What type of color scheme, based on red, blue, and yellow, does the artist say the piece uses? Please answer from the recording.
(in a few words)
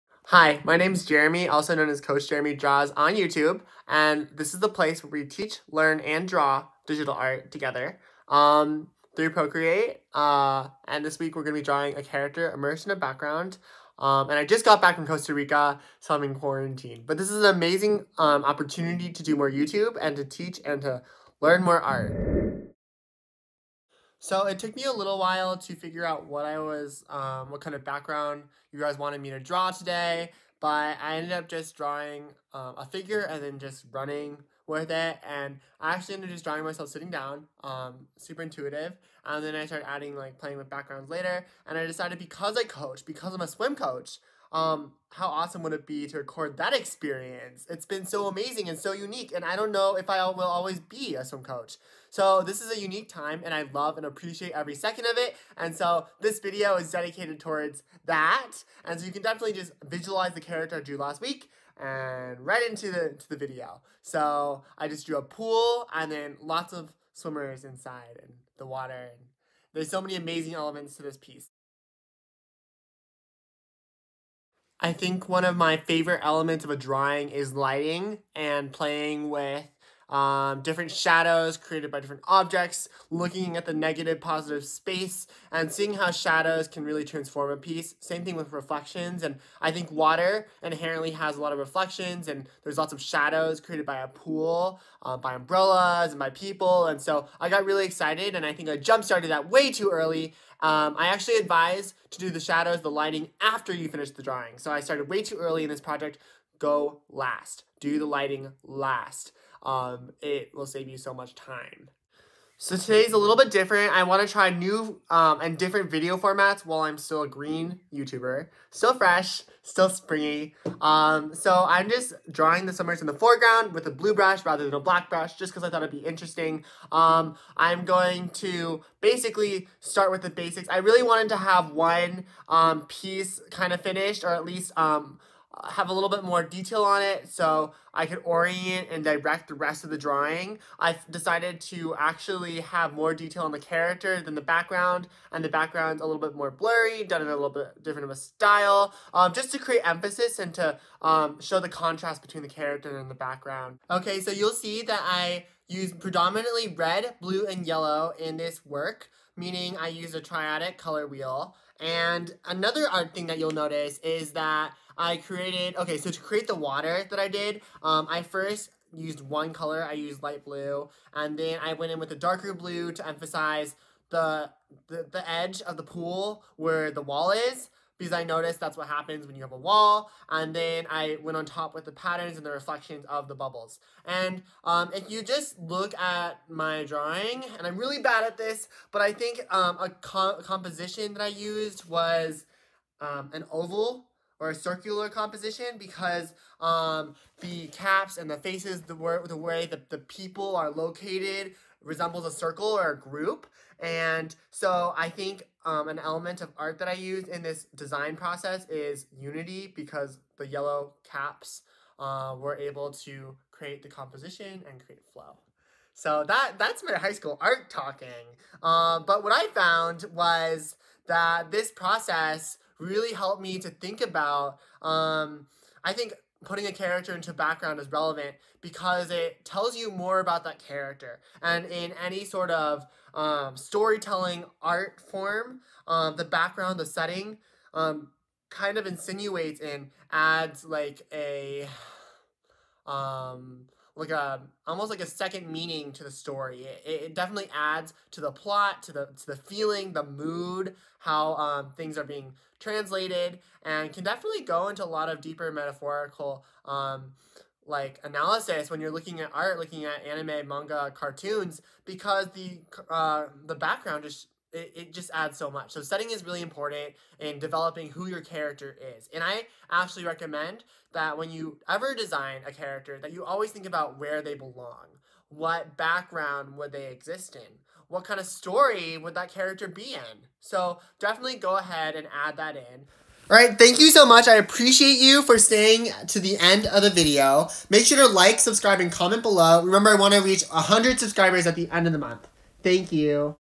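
Triadic.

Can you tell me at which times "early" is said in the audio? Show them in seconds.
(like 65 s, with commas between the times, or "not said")
99 s, 105 s.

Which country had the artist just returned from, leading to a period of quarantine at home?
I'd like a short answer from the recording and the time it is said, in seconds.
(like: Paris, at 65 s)
Costa Rica, at 15 s.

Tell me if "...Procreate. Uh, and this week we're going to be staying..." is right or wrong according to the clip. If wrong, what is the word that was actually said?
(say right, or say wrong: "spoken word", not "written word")
wrong: "drawing", not "staying".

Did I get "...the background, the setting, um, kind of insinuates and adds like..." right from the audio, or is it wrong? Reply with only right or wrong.
right.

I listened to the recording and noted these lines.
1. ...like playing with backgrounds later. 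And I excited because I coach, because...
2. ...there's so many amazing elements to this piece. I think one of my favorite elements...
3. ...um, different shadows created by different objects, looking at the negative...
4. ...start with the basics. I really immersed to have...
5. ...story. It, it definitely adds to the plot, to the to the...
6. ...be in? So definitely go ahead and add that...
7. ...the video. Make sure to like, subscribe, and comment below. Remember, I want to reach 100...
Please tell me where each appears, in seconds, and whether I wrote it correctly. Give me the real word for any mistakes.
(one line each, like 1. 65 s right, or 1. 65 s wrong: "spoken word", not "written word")
1. 40 s wrong: "decided", not "excited"
2. 69 s right
3. 80 s right
4. 129 s wrong: "wanted", not "immersed"
5. 246 s right
6. 279 s right
7. 286 s right.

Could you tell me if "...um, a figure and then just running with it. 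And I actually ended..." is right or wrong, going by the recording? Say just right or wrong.
right.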